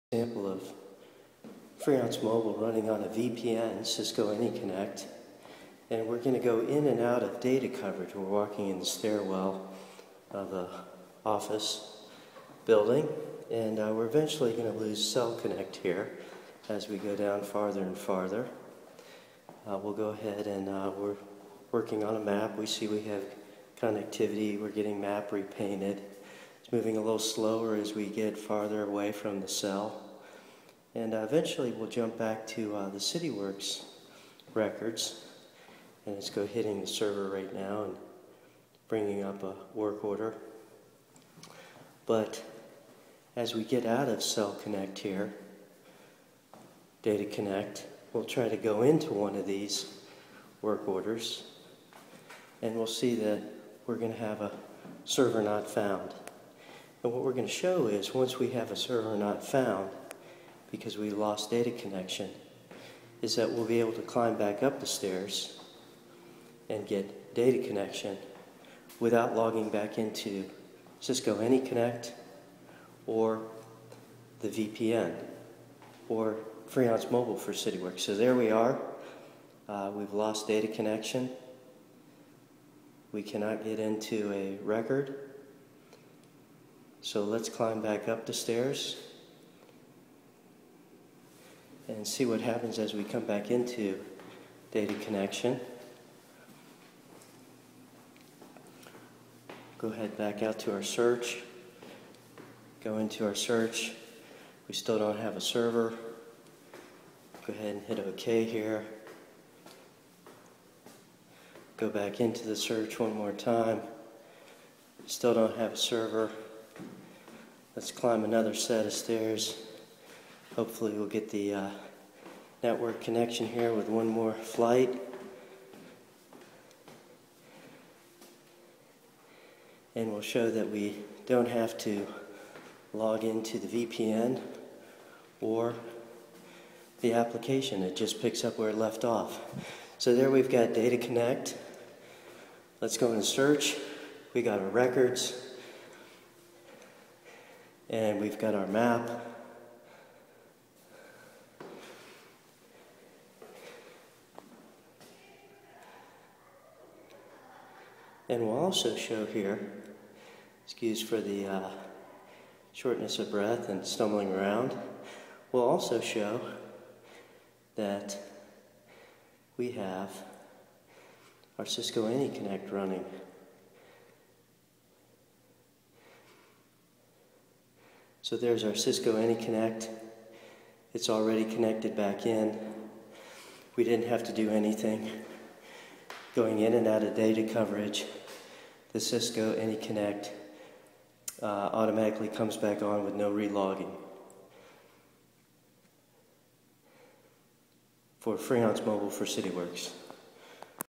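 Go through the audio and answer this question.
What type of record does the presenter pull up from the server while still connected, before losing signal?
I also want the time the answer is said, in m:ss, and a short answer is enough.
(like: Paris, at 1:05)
work order, at 0:39.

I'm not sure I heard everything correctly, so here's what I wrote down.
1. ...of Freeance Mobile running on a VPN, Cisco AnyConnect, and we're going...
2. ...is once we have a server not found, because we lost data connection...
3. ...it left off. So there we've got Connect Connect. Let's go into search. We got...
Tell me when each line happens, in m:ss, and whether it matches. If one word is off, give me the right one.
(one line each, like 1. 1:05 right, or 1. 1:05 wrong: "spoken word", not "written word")
1. 0:00 right
2. 0:57 right
3. 2:18 wrong: "Data", not "Connect".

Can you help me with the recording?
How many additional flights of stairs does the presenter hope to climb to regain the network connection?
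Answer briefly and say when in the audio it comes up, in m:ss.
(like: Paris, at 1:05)
1, at 2:03.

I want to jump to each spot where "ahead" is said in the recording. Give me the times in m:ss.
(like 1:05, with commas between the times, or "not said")
0:20, 1:39, 1:47.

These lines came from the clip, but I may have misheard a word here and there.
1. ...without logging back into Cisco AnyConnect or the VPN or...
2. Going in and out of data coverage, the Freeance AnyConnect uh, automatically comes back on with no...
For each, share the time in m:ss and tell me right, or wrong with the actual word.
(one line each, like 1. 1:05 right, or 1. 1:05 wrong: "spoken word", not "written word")
1. 1:08 right
2. 3:06 wrong: "Cisco", not "Freeance".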